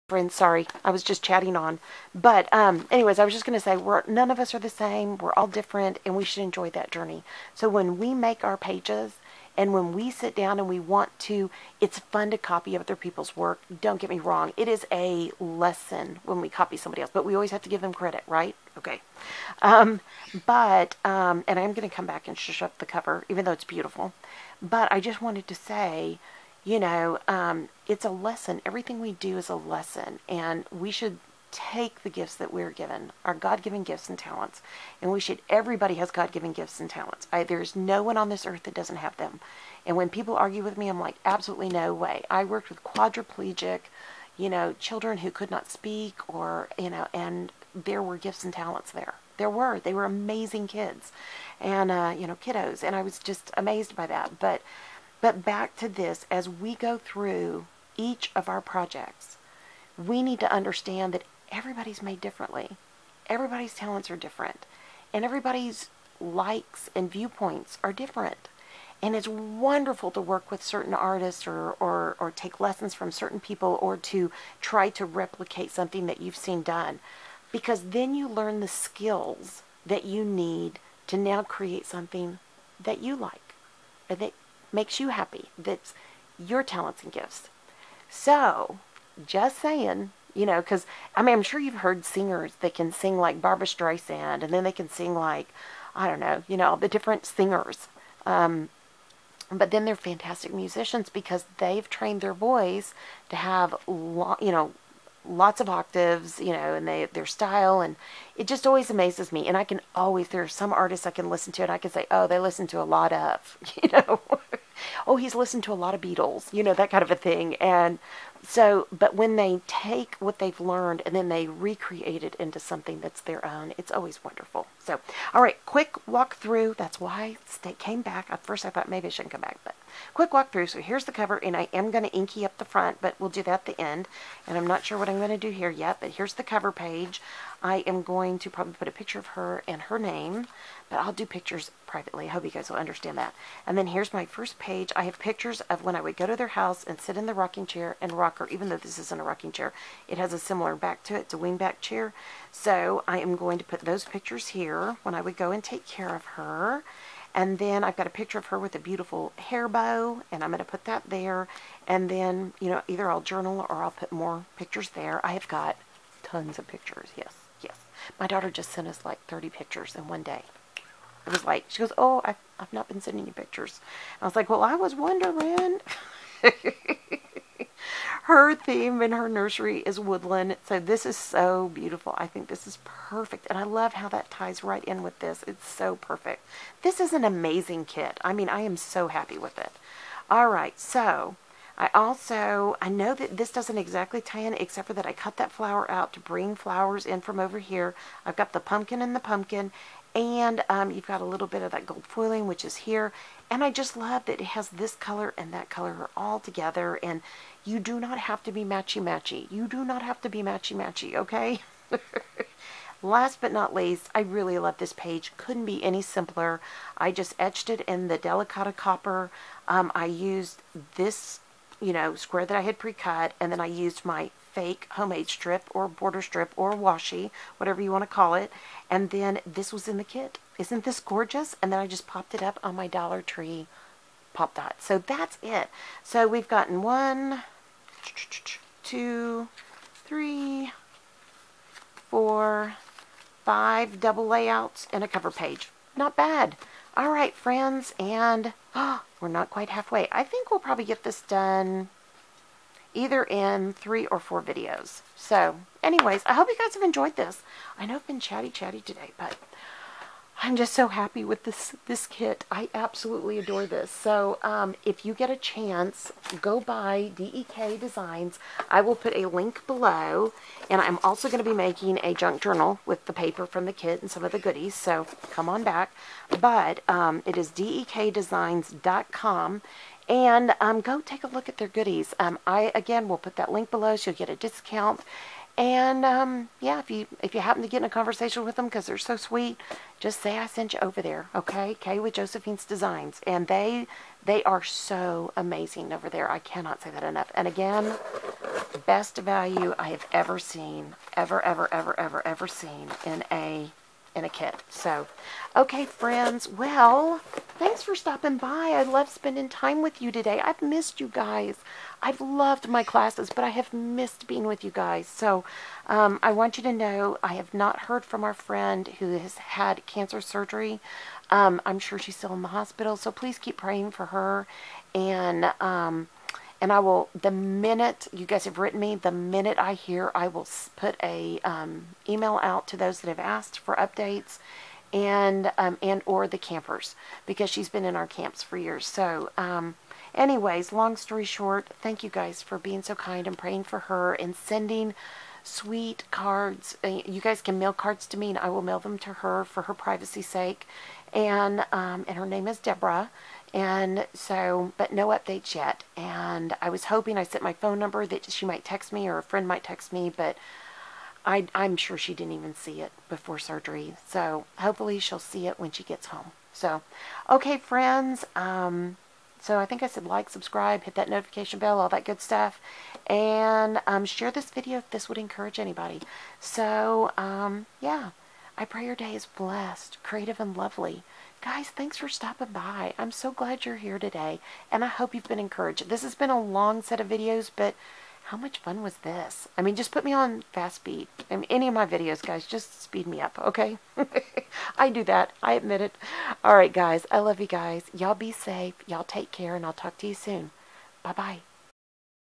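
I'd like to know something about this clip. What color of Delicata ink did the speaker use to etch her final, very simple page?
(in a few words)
Copper.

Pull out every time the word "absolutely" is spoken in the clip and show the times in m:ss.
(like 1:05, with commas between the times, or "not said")
0:41, 4:22.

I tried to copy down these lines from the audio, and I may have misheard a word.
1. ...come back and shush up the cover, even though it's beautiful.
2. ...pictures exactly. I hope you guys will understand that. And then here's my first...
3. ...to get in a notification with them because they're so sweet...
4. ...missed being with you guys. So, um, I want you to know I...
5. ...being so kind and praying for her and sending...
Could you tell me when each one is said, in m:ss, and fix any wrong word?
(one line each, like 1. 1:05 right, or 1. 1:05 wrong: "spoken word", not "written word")
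1. 0:21 right
2. 2:21 wrong: "privately", not "exactly"
3. 4:47 wrong: "conversation", not "notification"
4. 5:13 right
5. 5:42 right.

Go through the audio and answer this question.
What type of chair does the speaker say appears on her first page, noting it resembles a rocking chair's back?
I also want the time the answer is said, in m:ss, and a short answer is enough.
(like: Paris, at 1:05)
Wingback chair, at 2:31.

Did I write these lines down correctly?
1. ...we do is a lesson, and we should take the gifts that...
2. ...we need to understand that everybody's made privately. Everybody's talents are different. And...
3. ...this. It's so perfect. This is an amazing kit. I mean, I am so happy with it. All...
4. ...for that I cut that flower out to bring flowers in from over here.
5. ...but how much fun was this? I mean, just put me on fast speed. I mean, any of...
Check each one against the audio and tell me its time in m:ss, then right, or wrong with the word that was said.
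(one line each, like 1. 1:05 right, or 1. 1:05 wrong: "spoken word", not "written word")
1. 0:28 right
2. 0:59 wrong: "differently", not "privately"
3. 3:05 right
4. 3:14 right
5. 6:27 right.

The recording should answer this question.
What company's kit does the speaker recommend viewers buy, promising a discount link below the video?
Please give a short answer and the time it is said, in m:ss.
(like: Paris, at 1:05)
DEK Designs, at 4:27.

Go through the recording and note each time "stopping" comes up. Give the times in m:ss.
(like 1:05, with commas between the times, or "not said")
5:07, 6:22.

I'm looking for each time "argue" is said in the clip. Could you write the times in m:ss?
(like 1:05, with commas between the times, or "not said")
0:40.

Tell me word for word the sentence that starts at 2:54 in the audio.
I was like, well, I was wondering.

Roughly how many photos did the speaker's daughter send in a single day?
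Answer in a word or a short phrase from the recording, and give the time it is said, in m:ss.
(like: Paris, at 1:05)
30, at 2:49.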